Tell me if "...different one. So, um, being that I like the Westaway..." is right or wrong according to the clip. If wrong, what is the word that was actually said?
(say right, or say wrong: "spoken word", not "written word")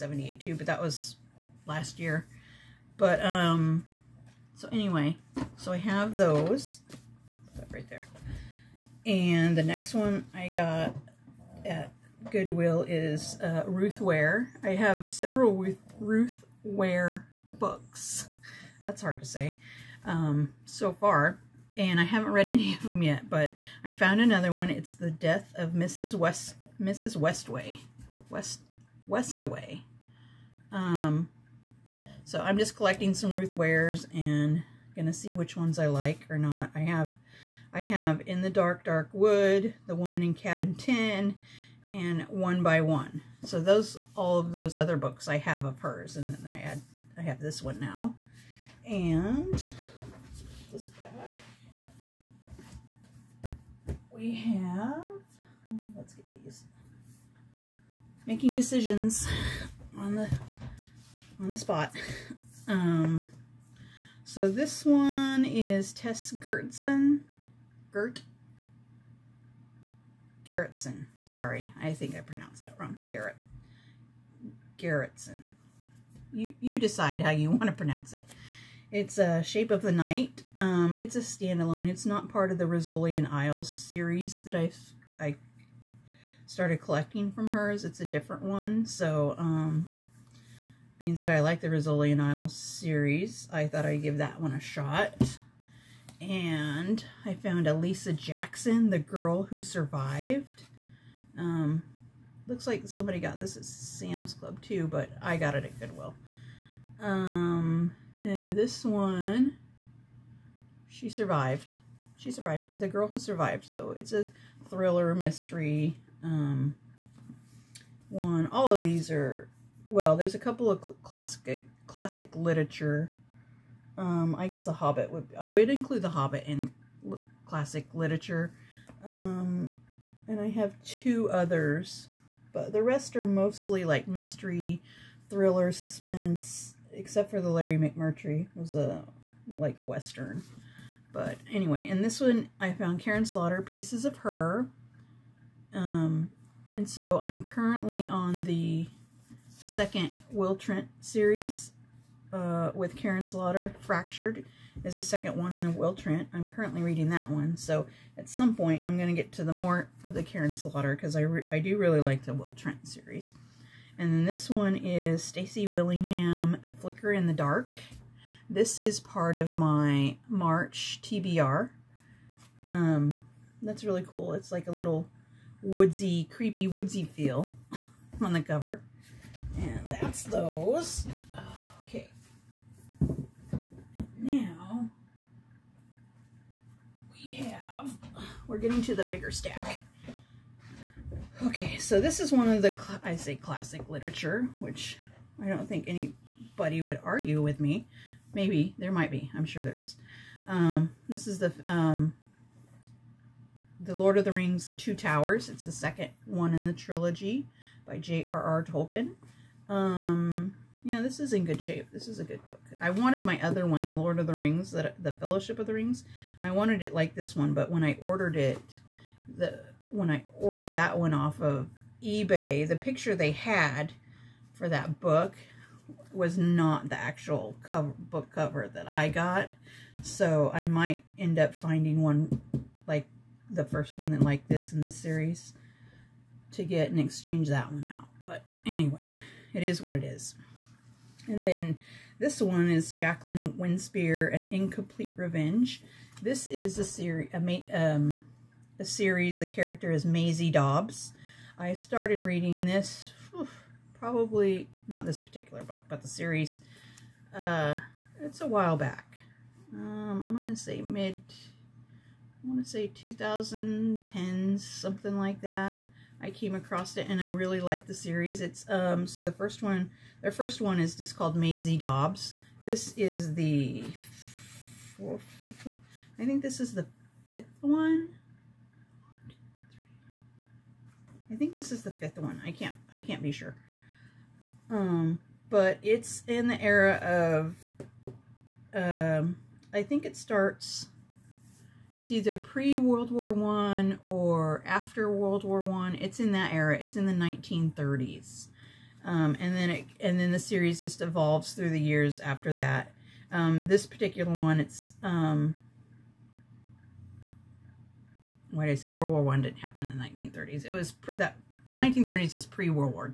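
wrong: "Rizzoli", not "Westaway".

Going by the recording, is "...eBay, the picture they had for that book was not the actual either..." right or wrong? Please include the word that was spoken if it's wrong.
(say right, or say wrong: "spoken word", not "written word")
wrong: "cover", not "either".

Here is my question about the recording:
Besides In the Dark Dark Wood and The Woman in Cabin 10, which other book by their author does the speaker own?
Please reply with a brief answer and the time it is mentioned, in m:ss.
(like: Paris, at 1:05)
One by One, at 0:42.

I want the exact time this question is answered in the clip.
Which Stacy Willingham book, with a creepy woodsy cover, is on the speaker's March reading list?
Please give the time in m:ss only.
2:46.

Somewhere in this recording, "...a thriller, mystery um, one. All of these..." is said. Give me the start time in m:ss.
1:54.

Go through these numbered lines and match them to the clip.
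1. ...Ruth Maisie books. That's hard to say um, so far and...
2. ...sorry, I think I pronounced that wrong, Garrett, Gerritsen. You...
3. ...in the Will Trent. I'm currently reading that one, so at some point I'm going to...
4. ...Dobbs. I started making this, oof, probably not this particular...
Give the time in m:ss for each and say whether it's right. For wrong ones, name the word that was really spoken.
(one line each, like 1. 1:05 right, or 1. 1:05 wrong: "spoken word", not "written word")
1. 0:15 wrong: "Ware", not "Maisie"
2. 1:11 right
3. 2:35 right
4. 4:10 wrong: "reading", not "making".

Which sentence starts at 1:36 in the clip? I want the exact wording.
And I found Elisa Jackson, the girl who survived.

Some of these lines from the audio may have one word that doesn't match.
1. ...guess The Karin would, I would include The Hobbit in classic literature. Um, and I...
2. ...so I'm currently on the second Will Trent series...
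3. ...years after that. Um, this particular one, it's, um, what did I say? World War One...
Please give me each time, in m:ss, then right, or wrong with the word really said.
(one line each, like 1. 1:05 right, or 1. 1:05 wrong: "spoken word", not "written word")
1. 2:04 wrong: "Hobbit", not "Karin"
2. 2:26 right
3. 5:01 right.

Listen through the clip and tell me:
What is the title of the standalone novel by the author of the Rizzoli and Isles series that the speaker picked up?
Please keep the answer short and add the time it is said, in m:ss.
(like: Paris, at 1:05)
Shape of the Night, at 1:19.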